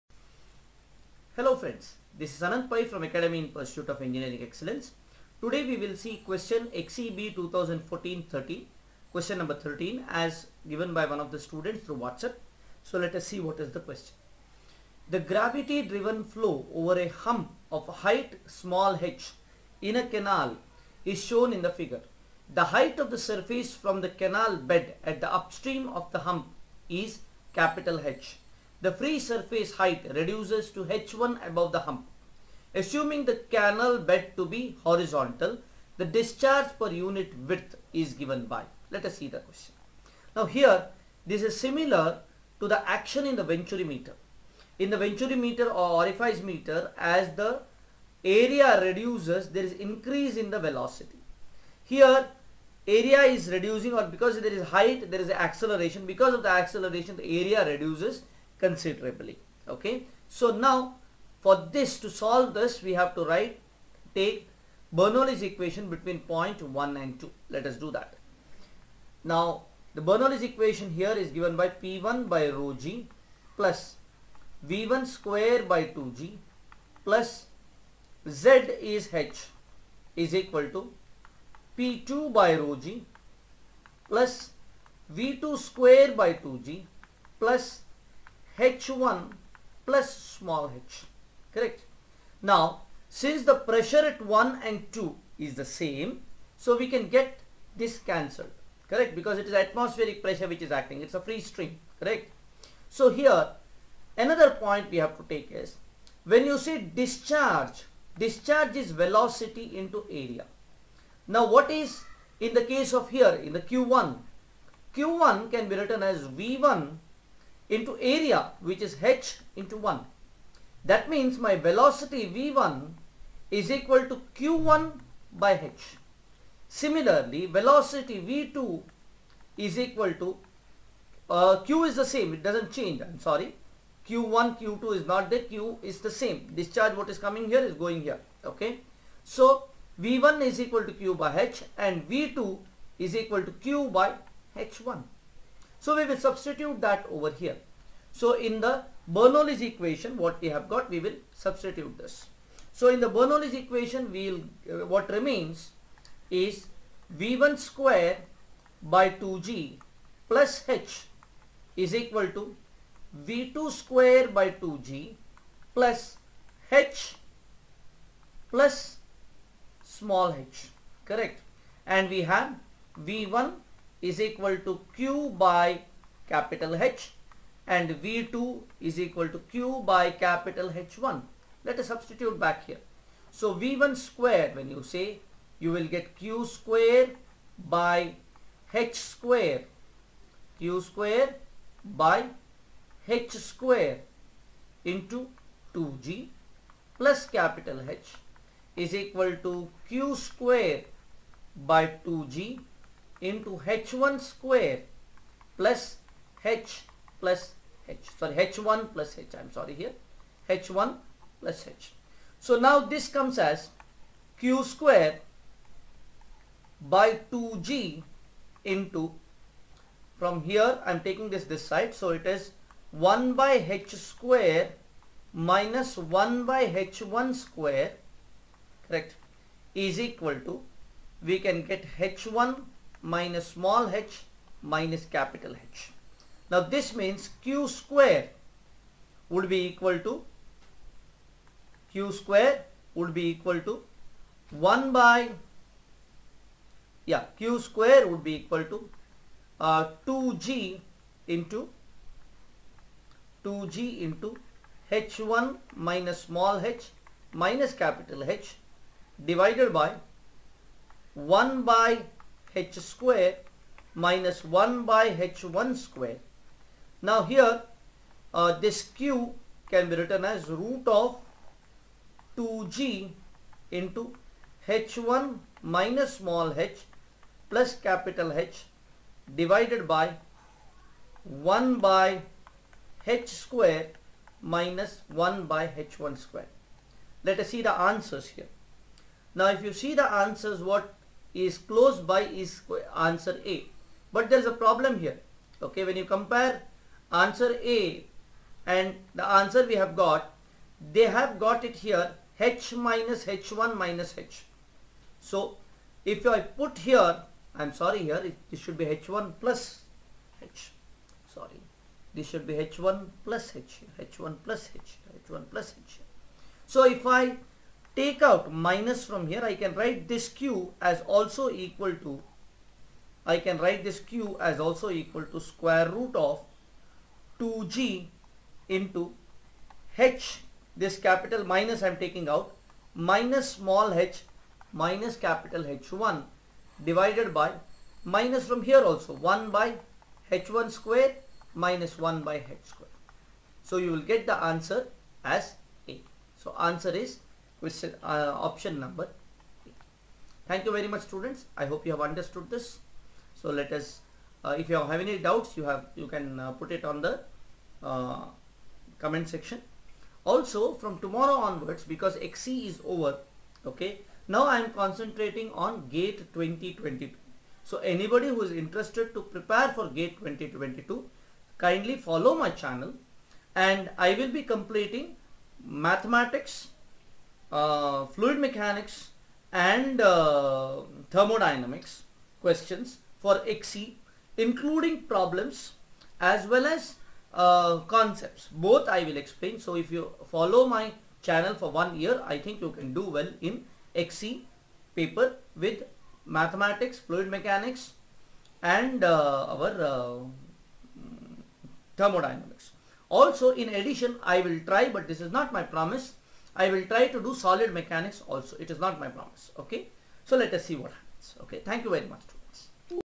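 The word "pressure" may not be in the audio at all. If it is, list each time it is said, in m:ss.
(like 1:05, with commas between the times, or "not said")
1:33, 1:40.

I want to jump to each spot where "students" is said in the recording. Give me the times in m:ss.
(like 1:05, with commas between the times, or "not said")
0:11, 5:51.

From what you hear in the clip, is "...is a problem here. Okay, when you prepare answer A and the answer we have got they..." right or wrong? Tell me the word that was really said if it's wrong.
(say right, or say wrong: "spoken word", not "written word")
wrong: "compare", not "prepare".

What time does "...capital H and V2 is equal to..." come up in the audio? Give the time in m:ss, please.
2:56.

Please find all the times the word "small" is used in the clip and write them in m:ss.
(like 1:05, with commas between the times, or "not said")
0:18, 1:30, 2:49, 3:53, 4:16, 4:36, 5:33.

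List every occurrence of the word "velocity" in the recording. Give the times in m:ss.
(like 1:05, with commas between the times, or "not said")
0:50, 1:48, 2:01, 2:07.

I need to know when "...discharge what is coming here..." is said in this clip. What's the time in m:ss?
2:16.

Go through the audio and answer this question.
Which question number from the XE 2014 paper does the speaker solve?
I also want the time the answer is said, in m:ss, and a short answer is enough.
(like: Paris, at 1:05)
13, at 0:09.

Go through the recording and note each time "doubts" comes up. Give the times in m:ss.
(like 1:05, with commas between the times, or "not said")
5:55.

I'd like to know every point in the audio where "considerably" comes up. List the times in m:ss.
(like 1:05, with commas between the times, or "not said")
0:58.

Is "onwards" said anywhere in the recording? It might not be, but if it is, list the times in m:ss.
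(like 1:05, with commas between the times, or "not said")
6:01.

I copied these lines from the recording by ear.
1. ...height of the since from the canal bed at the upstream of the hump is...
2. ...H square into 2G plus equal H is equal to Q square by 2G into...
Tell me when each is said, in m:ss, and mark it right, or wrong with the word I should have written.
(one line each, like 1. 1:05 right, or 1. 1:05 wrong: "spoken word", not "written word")
1. 0:22 wrong: "surface", not "since"
2. 3:13 wrong: "capital", not "equal".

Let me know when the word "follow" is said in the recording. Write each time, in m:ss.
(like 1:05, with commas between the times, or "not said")
6:11, 6:30.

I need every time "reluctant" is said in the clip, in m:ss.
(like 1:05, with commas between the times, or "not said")
not said.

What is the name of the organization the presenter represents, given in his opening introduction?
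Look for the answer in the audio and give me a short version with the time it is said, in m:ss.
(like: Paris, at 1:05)
Academy in Pursuit of Engineering Excellence, at 0:03.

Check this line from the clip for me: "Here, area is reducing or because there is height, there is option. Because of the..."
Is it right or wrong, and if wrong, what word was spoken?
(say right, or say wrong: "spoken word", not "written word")
wrong: "acceleration", not "option".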